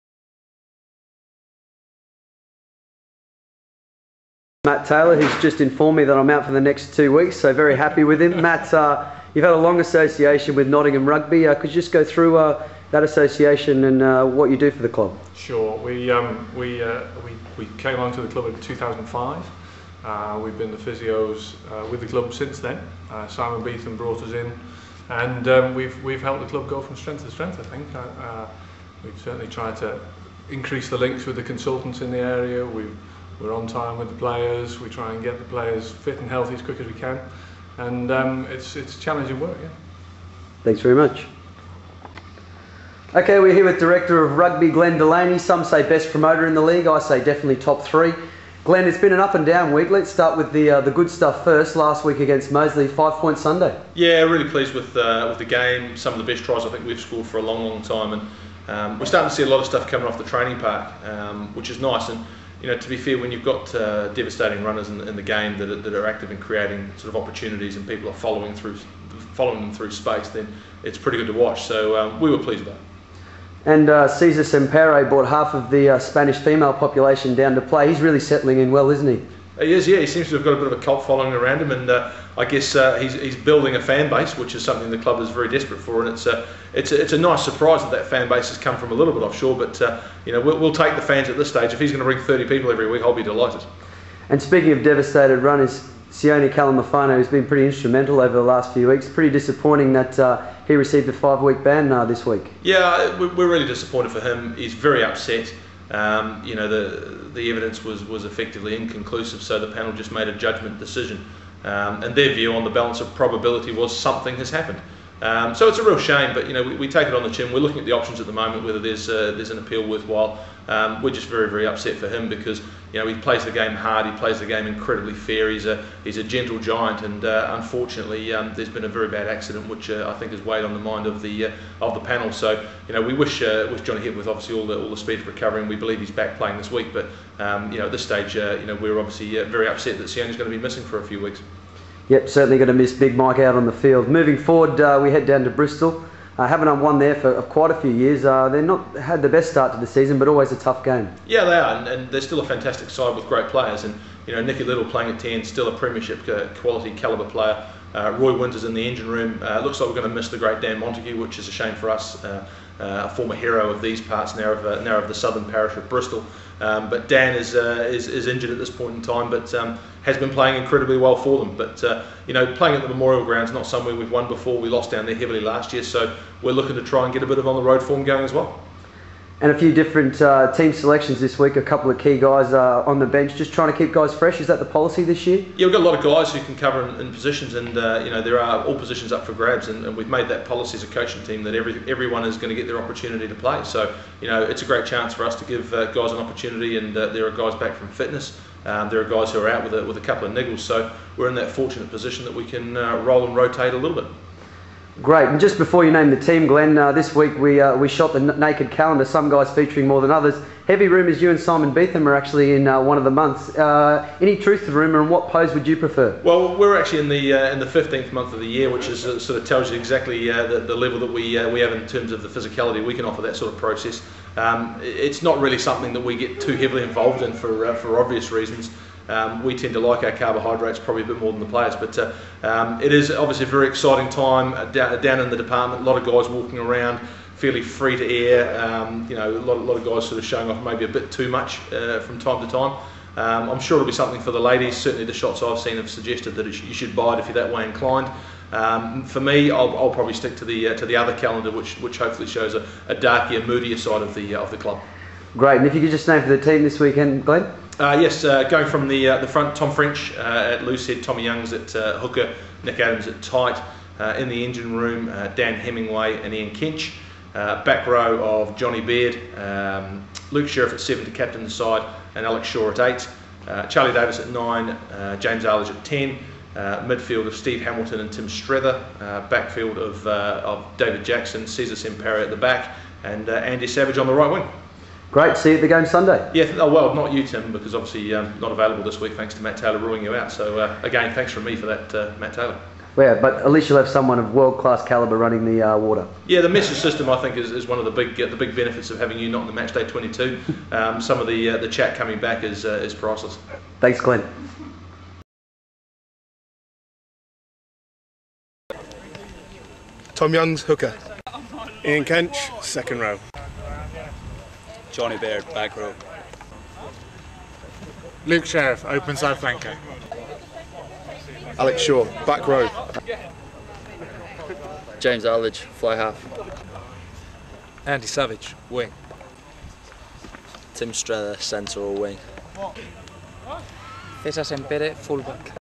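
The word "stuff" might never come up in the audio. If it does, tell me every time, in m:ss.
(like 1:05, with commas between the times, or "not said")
0:51, 0:59.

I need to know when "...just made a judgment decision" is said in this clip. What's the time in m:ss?
1:49.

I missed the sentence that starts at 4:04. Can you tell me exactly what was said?
Certainly, the shots I've seen have suggested that sh you should buy it if you're that way inclined.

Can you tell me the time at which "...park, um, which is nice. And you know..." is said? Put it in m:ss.
1:00.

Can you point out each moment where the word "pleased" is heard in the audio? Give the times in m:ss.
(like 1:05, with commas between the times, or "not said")
0:54, 1:12.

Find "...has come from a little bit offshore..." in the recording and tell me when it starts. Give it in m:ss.
1:28.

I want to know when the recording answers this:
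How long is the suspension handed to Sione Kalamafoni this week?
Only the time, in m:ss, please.
1:41.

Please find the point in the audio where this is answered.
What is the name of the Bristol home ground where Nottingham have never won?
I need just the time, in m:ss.
2:52.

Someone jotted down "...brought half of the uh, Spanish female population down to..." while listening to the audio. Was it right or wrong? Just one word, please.
right.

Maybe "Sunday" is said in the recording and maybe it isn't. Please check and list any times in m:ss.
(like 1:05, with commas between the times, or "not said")
0:53, 4:45.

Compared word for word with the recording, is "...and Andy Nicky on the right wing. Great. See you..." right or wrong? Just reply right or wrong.
wrong.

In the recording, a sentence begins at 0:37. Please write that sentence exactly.
And um, it's, it's challenging work, yeah.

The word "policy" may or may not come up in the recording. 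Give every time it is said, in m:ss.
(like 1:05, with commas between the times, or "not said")
3:04, 3:10.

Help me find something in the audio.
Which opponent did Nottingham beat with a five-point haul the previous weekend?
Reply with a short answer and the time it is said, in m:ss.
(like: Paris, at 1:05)
Moseley, at 0:52.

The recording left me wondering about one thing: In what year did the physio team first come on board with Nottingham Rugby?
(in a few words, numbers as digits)
2005.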